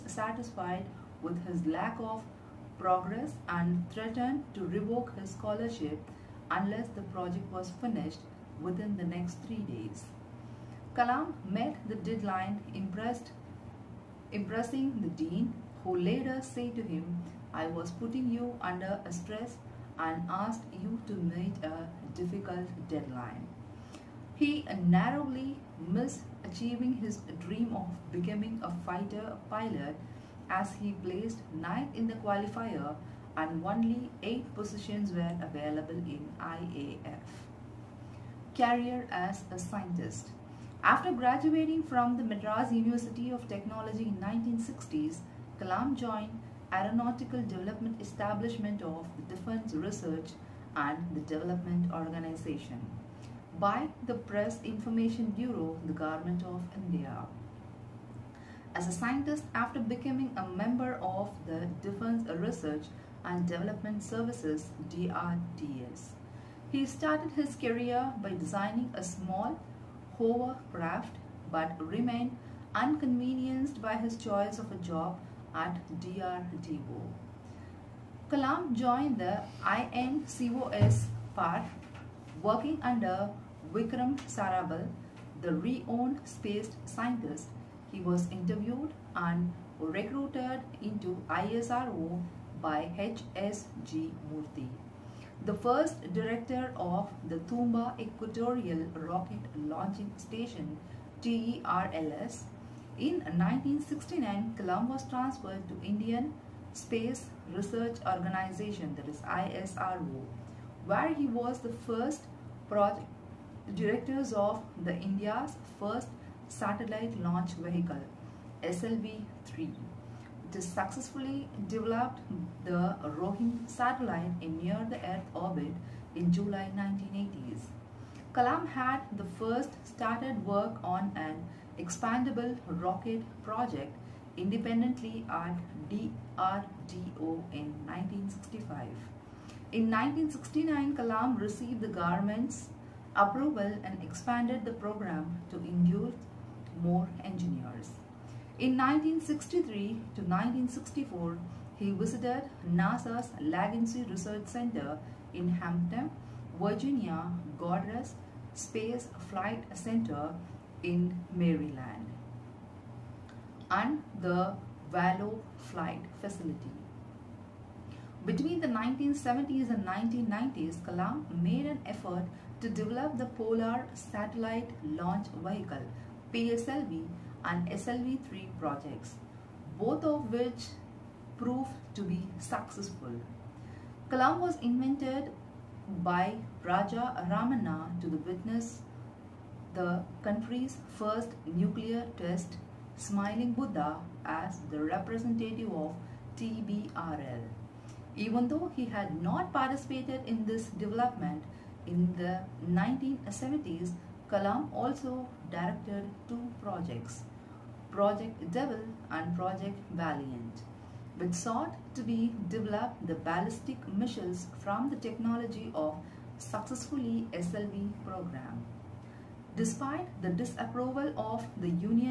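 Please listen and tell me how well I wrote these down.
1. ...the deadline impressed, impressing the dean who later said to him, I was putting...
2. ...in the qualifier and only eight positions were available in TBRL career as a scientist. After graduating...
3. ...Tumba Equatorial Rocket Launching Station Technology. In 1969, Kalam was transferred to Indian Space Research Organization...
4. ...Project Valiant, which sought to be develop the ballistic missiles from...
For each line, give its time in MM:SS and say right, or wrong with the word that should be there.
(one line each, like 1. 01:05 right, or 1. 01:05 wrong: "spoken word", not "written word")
1. 00:11 right
2. 00:31 wrong: "IAF", not "TBRL"
3. 01:37 wrong: "TERLS", not "Technology"
4. 03:29 right.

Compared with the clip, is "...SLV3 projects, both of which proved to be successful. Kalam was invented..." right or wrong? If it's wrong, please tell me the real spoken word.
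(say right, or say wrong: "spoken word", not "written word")
right.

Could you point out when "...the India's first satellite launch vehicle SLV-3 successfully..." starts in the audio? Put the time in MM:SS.
01:54.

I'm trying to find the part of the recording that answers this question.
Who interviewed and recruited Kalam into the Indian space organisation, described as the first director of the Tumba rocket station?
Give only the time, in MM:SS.
01:32.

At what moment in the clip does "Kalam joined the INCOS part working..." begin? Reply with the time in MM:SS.
01:18.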